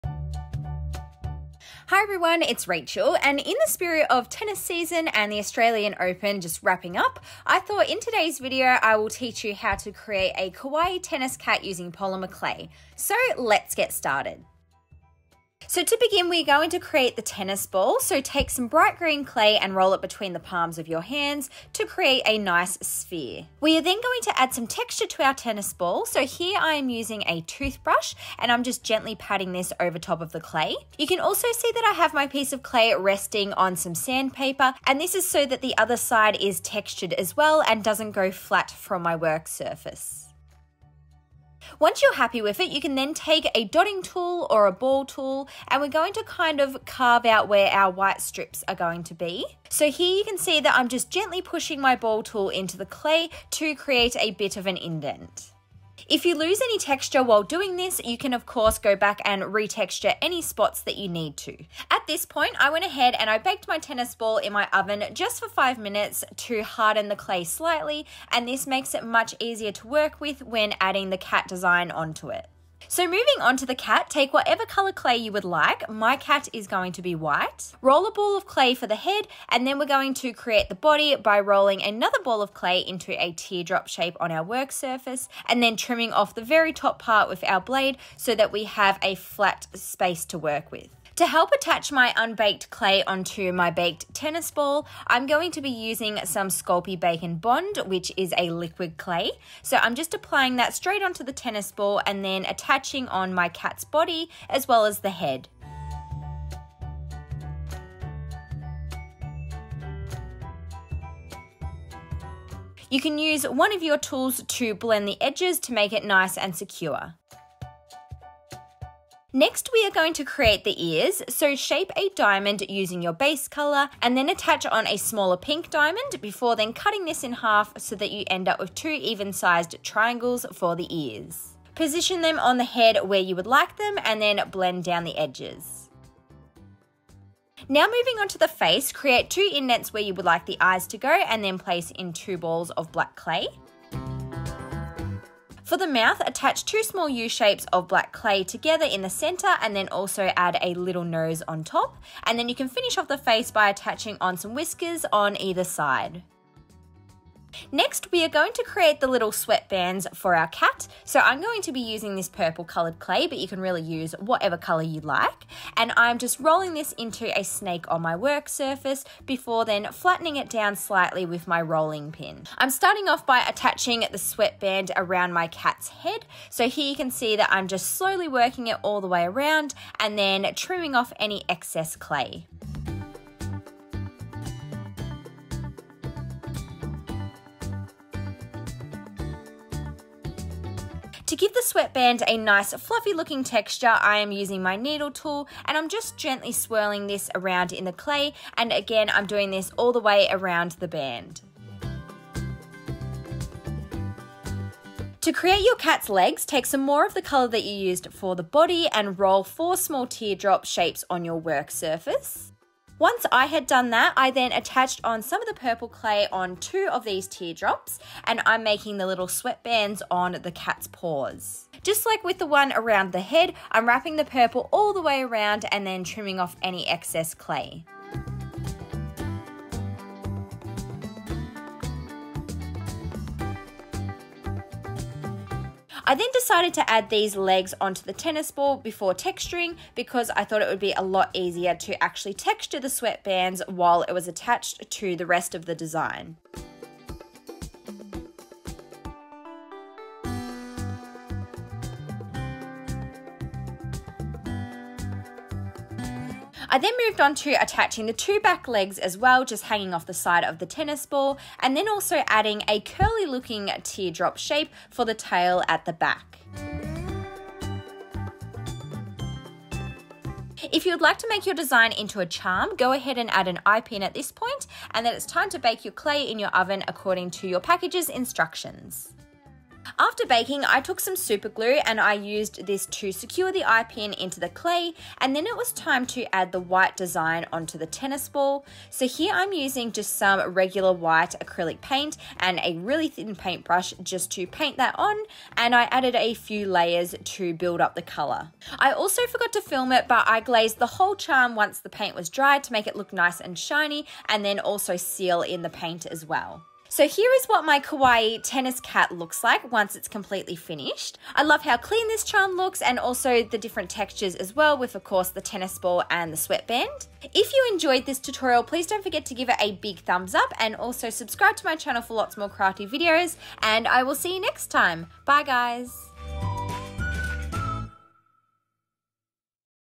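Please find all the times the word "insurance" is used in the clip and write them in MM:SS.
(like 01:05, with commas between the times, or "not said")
not said.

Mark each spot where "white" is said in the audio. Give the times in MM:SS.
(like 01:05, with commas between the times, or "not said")
00:47, 01:17, 04:46, 04:50.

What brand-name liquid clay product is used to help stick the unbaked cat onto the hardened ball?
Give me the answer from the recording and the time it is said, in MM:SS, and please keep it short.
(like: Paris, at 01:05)
Sculpey Bake and Bond, at 01:36.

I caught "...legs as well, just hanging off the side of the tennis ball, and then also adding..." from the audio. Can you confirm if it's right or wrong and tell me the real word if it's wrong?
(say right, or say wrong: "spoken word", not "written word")
right.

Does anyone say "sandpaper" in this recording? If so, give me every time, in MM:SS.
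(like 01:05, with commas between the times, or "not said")
00:33.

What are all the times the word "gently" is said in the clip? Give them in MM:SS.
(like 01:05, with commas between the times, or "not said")
00:28, 00:51, 03:16.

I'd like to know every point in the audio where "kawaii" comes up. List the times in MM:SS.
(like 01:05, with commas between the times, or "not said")
00:10, 05:07.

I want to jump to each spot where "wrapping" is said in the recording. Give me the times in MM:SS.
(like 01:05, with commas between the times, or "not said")
00:06, 03:43.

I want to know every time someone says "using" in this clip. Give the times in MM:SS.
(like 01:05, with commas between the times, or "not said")
00:11, 00:26, 01:35, 02:02, 02:41, 03:14, 04:49.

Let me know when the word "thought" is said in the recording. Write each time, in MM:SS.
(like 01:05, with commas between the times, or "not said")
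00:07, 04:00.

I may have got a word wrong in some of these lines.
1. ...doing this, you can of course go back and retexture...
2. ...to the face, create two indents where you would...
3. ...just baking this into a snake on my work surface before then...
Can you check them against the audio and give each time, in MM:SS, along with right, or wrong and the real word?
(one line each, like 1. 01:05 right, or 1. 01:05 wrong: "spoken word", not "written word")
1. 00:57 right
2. 02:18 right
3. 02:46 wrong: "rolling", not "baking".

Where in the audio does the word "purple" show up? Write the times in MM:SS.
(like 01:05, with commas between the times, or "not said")
02:42, 03:35, 03:44.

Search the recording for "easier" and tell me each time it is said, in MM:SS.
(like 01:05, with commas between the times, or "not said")
01:09, 04:01.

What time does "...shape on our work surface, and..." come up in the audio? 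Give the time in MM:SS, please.
01:23.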